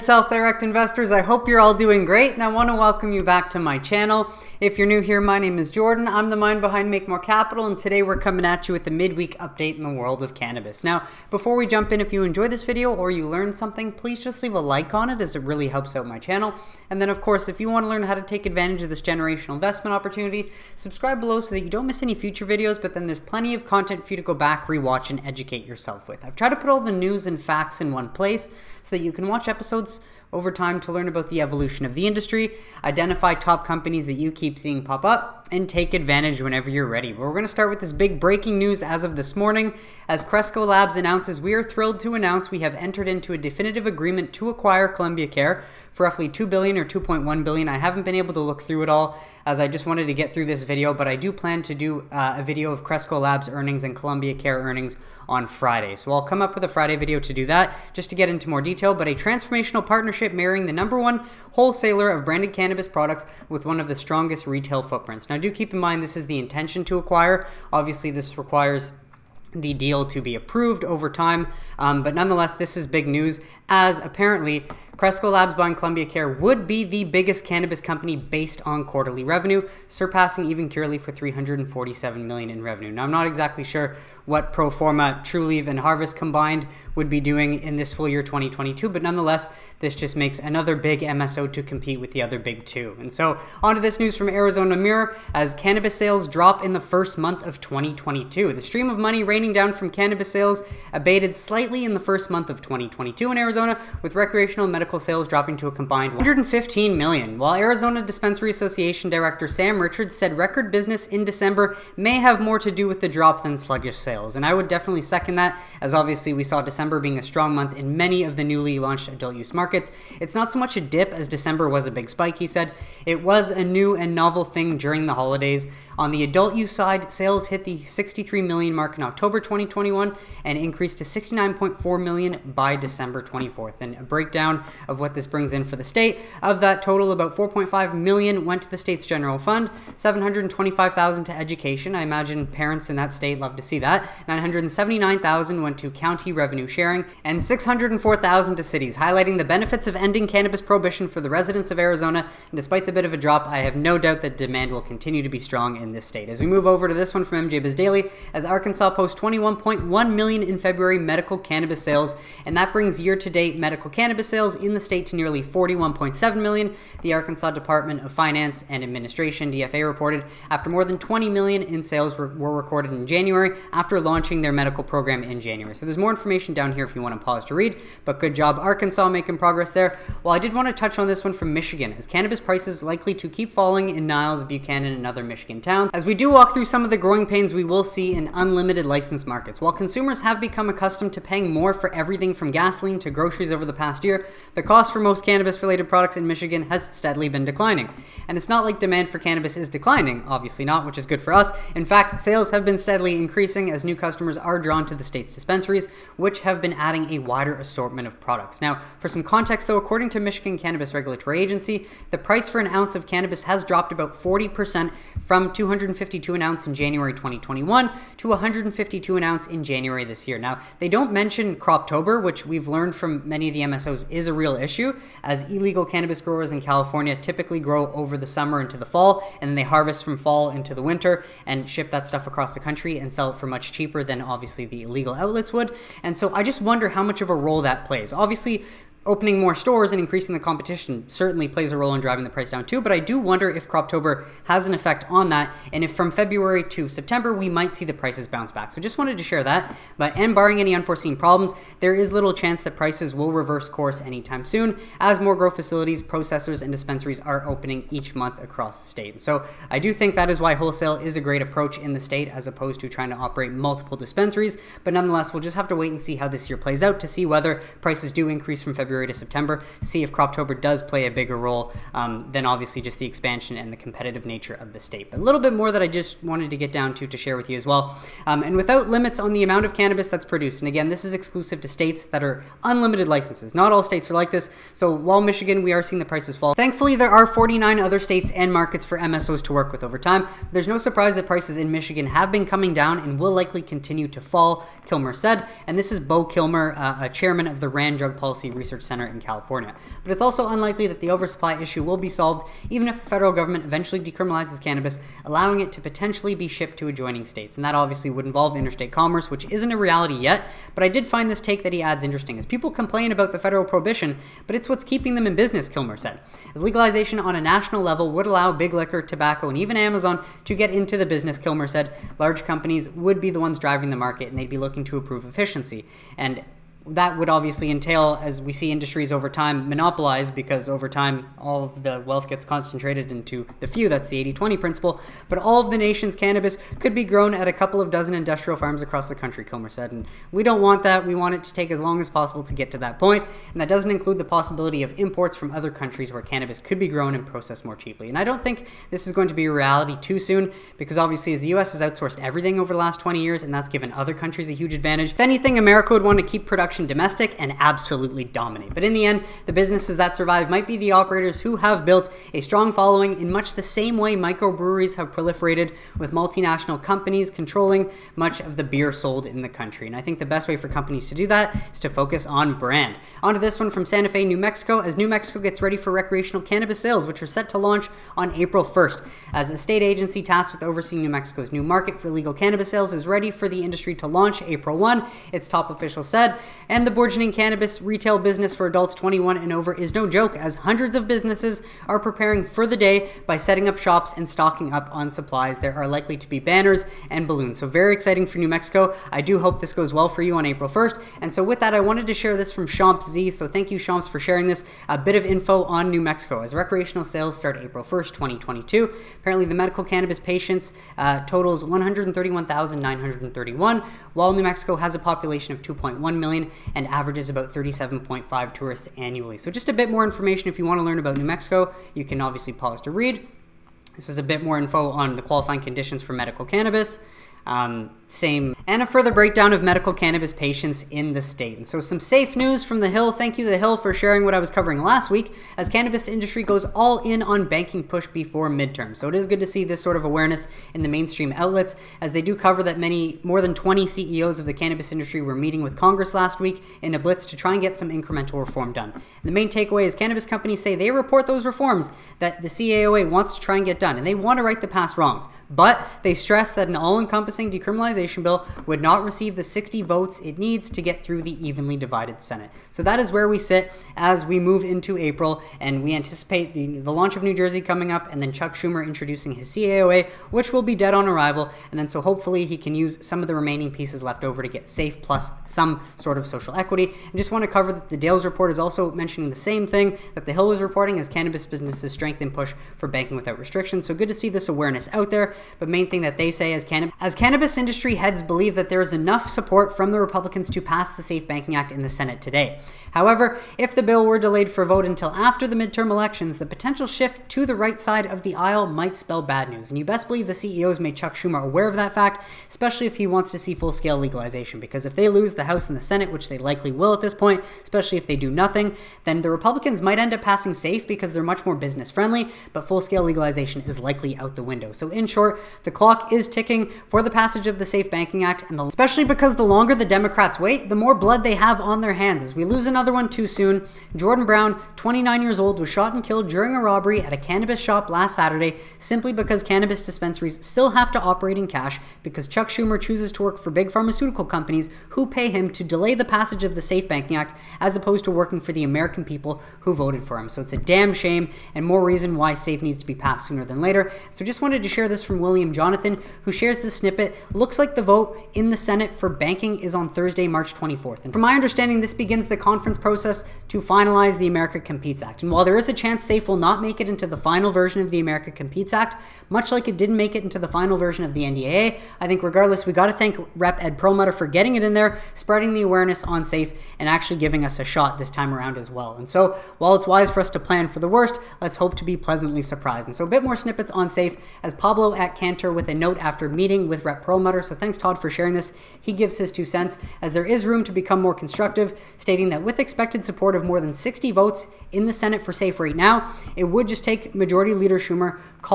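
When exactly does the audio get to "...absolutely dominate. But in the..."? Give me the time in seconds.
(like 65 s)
357 s.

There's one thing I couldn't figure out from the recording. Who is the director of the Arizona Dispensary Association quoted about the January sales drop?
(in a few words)
Sam Richards.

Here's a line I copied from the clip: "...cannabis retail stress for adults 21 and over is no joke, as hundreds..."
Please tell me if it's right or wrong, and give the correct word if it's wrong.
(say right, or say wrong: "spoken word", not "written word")
wrong: "business", not "stress".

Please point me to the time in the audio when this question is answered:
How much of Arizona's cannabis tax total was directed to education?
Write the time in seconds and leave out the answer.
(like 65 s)
139 s.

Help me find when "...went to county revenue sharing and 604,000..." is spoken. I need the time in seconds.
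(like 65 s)
145 s.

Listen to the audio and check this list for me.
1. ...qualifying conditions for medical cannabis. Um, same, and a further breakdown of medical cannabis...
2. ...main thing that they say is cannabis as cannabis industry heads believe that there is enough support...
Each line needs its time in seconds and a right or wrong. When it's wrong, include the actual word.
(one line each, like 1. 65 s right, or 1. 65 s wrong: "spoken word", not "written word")
1. 425 s right
2. 485 s right.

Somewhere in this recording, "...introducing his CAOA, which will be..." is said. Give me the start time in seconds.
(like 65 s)
468 s.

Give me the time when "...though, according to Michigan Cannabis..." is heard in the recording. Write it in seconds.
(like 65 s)
209 s.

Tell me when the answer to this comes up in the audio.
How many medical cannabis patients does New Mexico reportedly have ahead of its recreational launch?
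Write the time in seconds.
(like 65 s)
411 s.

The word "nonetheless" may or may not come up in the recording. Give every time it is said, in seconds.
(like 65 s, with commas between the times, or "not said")
72 s, 89 s, 264 s.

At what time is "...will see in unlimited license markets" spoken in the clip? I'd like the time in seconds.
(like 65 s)
187 s.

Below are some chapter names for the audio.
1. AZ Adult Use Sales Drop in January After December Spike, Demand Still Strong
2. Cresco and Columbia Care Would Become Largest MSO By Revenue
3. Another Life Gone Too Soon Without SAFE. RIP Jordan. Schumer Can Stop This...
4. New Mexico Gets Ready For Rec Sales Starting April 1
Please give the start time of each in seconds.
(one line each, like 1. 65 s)
1. 95 s
2. 73 s
3. 522 s
4. 373 s.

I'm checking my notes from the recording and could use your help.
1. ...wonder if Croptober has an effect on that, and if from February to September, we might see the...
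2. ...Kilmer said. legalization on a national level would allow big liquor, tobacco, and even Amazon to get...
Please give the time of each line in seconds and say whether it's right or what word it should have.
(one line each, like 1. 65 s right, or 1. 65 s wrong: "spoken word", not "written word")
1. 243 s right
2. 315 s right.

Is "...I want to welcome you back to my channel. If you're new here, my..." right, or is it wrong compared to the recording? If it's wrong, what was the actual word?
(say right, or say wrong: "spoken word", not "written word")
right.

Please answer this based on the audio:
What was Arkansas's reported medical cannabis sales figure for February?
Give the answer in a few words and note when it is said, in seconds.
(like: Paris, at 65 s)
21.1 million, at 159 s.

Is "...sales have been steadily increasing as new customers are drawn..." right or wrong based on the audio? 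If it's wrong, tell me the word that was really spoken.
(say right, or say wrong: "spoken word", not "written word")
right.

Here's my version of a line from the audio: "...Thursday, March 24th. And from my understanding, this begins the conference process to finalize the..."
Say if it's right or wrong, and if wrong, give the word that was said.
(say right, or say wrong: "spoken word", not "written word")
right.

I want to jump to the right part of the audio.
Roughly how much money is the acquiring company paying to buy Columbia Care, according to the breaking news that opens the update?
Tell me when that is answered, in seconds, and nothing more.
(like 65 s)
46 s.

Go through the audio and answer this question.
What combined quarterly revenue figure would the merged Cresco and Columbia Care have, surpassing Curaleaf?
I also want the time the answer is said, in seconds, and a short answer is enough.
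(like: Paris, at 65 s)
347 million, at 81 s.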